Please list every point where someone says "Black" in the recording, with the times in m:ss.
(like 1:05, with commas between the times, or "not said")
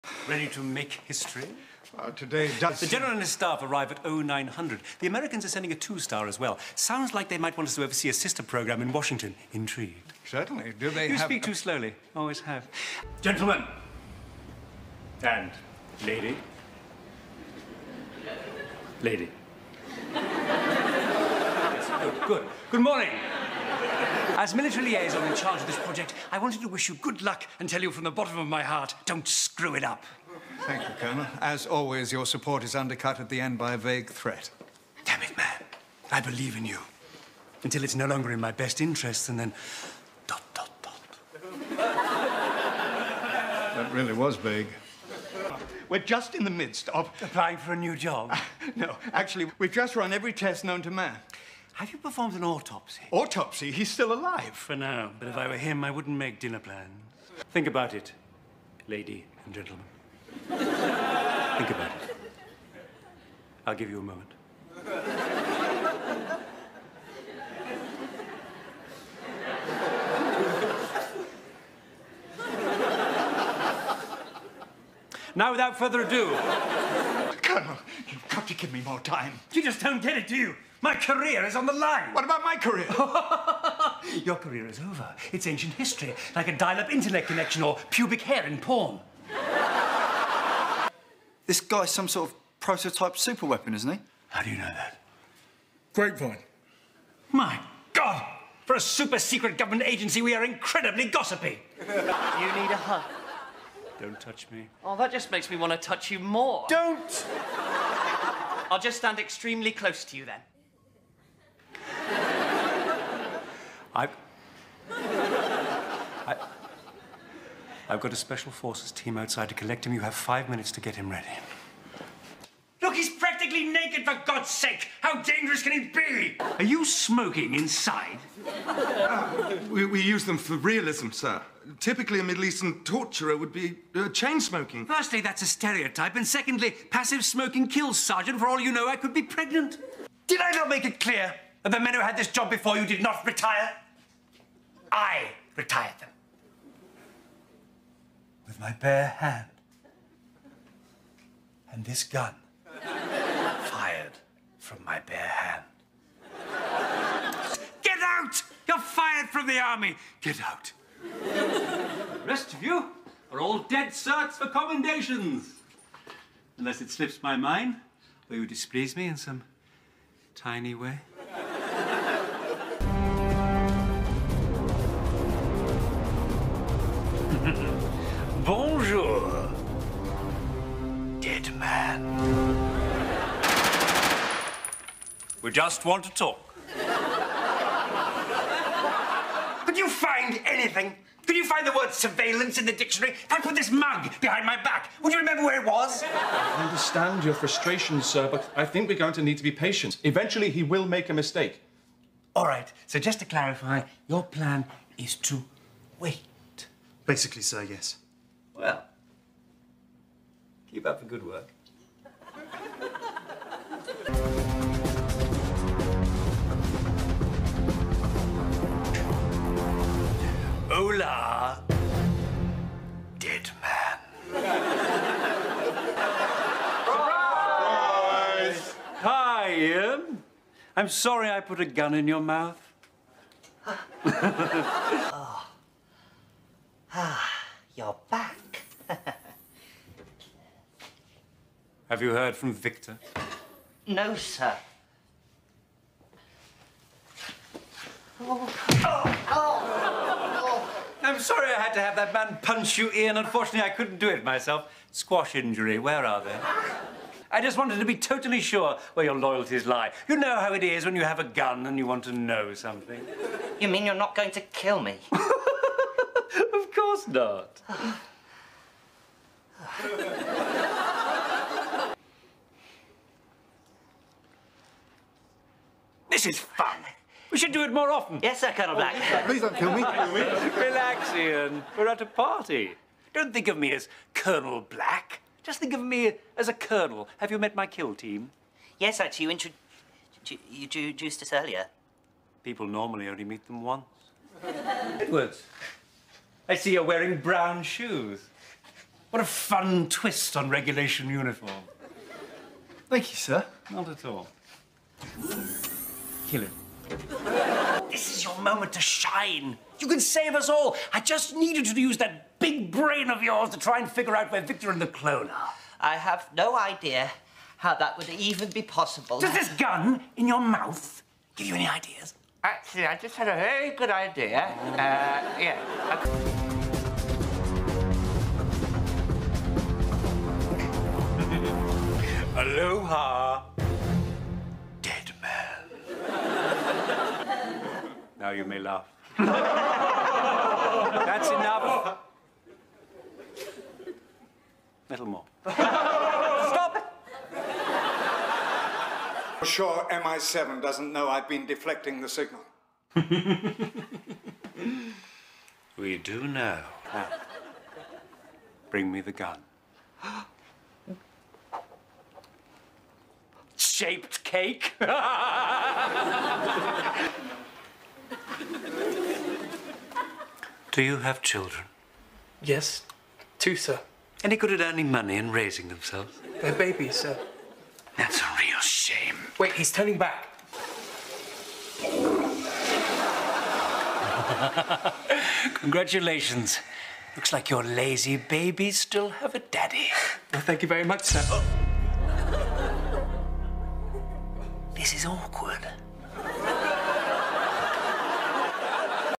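4:38, 4:44.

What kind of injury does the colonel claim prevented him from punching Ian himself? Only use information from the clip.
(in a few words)
Squash injury.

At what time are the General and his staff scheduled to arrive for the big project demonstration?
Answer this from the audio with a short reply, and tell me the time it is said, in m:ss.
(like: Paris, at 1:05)
0900, at 0:04.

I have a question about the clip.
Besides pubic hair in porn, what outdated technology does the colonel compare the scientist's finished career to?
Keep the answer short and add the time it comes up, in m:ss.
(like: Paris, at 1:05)
dial-up internet connection, at 1:26.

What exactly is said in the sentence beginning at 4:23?
You mean you're not going to kill me?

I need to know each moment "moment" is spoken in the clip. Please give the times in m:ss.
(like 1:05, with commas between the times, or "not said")
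1:04, 5:08.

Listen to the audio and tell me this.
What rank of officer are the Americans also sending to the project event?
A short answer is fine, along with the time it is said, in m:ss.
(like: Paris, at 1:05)
two-star, at 0:05.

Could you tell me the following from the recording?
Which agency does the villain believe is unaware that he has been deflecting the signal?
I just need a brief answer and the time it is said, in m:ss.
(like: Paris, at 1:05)
MI7, at 5:49.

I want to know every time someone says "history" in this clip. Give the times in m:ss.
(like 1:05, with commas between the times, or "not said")
0:01, 1:25.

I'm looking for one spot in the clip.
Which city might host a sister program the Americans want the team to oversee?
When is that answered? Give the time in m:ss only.
0:08.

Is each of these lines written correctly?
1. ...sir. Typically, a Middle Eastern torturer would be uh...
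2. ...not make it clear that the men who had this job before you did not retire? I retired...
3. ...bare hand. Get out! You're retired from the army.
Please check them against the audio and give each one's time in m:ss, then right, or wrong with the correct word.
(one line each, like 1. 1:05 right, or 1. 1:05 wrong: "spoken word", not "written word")
1. 2:11 right
2. 2:20 right
3. 2:34 wrong: "fired", not "retired".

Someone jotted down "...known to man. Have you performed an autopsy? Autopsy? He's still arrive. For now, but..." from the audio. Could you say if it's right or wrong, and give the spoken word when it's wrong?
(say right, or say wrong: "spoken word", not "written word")
wrong: "alive", not "arrive".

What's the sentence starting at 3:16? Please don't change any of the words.
I understand your frustration, sir, but I think we're going to need to be patient.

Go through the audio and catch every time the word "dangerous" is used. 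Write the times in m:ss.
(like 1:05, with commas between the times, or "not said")
2:05.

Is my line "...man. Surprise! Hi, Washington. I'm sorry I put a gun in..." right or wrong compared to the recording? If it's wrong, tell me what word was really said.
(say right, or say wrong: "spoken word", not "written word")
wrong: "Ian", not "Washington".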